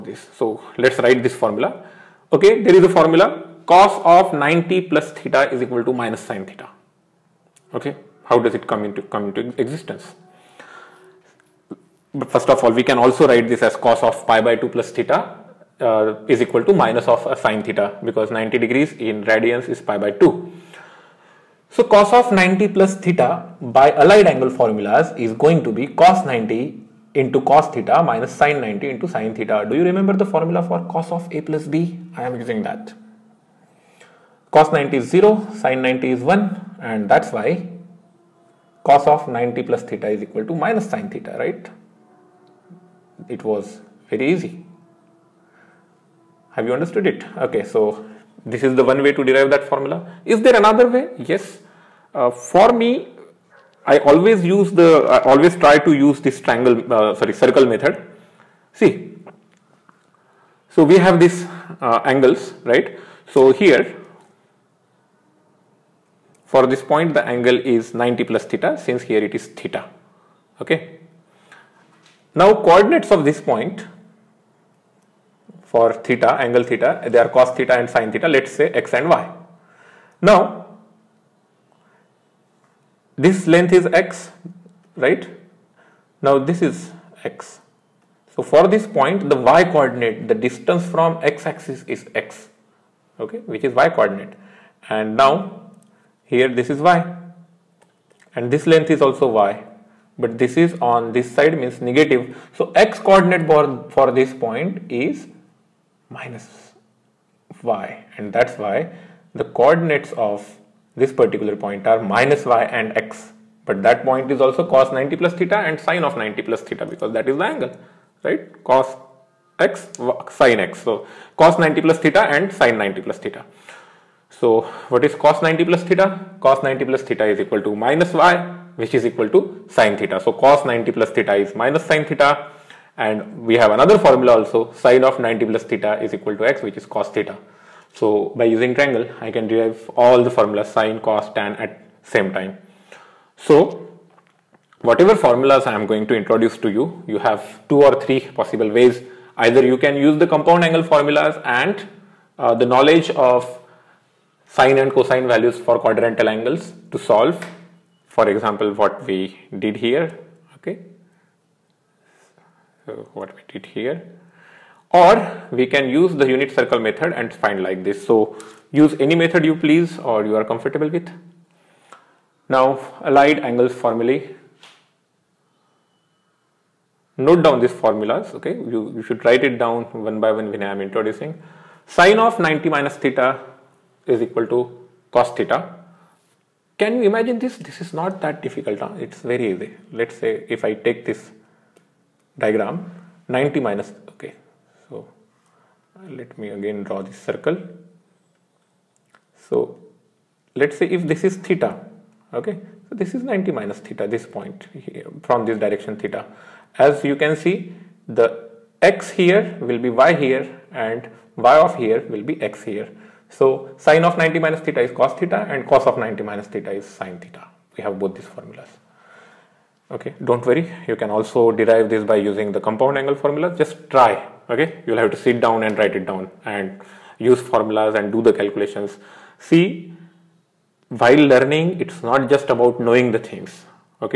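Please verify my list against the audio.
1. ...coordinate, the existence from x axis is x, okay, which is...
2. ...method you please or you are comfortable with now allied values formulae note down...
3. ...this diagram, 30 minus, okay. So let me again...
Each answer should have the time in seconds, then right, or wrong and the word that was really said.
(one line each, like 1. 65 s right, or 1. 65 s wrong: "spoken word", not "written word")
1. 89 s wrong: "distance", not "existence"
2. 169 s wrong: "angles", not "values"
3. 191 s wrong: "90", not "30".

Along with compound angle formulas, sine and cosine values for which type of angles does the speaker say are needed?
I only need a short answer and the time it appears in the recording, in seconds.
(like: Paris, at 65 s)
quadrantal angles, at 155 s.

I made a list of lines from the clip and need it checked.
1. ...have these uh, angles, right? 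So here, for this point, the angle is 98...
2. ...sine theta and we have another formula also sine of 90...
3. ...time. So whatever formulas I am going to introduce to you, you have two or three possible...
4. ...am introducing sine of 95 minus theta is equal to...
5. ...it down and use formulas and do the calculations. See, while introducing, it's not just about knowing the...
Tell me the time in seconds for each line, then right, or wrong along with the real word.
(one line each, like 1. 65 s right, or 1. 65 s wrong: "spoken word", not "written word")
1. 60 s wrong: "90", not "98"
2. 131 s right
3. 142 s right
4. 180 s wrong: "90", not "95"
5. 225 s wrong: "learning", not "introducing".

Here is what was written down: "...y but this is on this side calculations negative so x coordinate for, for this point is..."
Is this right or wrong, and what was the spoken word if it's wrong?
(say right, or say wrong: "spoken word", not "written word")
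wrong: "means", not "calculations".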